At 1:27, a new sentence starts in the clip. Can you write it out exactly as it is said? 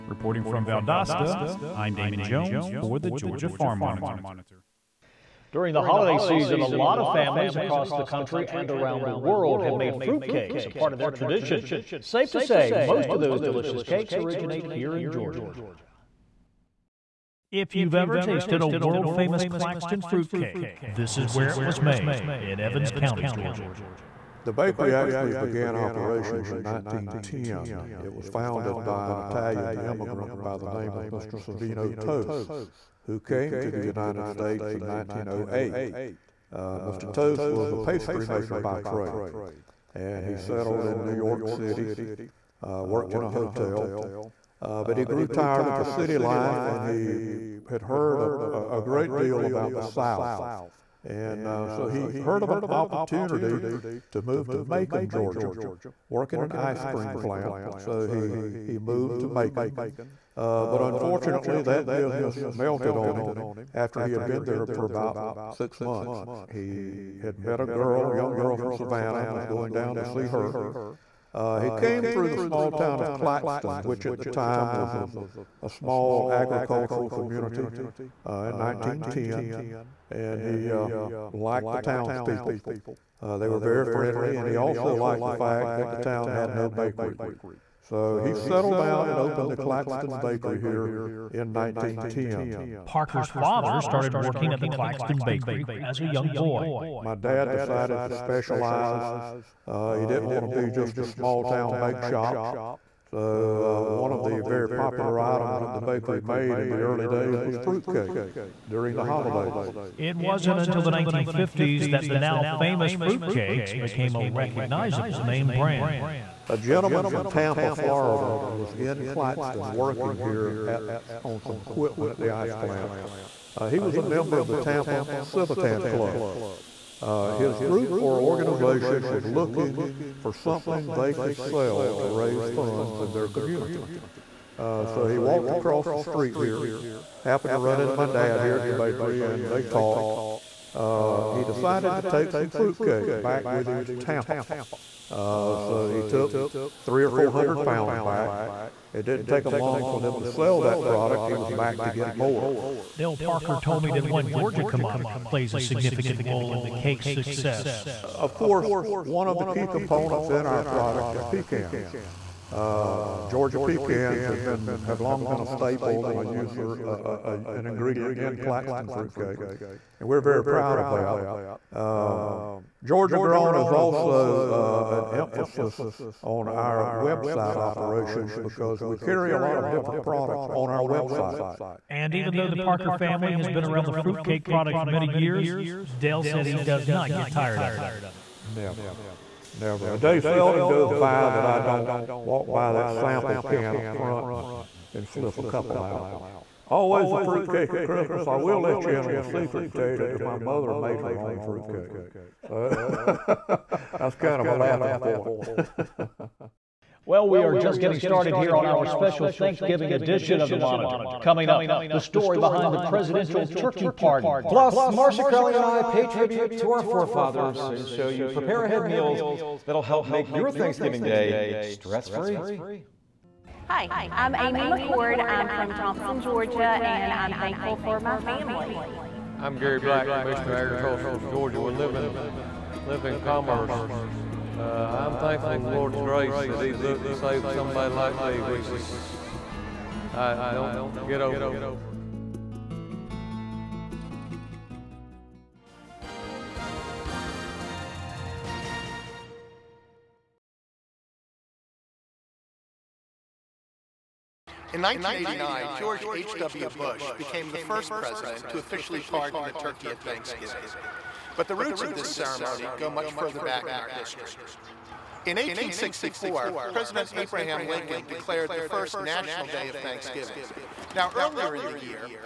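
So he settled down and opened the Claxton Bakery here in 1910.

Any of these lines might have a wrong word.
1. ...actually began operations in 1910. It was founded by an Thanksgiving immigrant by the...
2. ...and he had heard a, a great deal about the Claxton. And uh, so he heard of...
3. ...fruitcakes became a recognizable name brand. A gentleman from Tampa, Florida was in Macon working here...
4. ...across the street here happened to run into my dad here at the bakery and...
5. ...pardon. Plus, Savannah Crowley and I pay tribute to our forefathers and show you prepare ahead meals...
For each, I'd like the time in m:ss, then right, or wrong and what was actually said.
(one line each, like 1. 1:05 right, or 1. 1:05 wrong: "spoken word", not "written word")
1. 0:24 wrong: "Italian", not "Thanksgiving"
2. 0:46 wrong: "South", not "Claxton"
3. 1:52 wrong: "Claxton", not "Macon"
4. 2:15 right
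5. 3:33 wrong: "Marcia", not "Savannah".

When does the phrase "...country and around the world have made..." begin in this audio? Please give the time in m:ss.
0:08.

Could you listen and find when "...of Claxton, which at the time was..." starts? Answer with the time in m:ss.
1:13.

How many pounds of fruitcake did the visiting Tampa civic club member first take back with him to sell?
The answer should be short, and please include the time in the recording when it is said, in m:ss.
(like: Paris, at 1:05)
300 or 400 pounds, at 2:26.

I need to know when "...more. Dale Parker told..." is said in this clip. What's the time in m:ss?
2:32.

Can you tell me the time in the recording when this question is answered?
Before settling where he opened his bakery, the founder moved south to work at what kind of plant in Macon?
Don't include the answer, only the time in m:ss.
0:56.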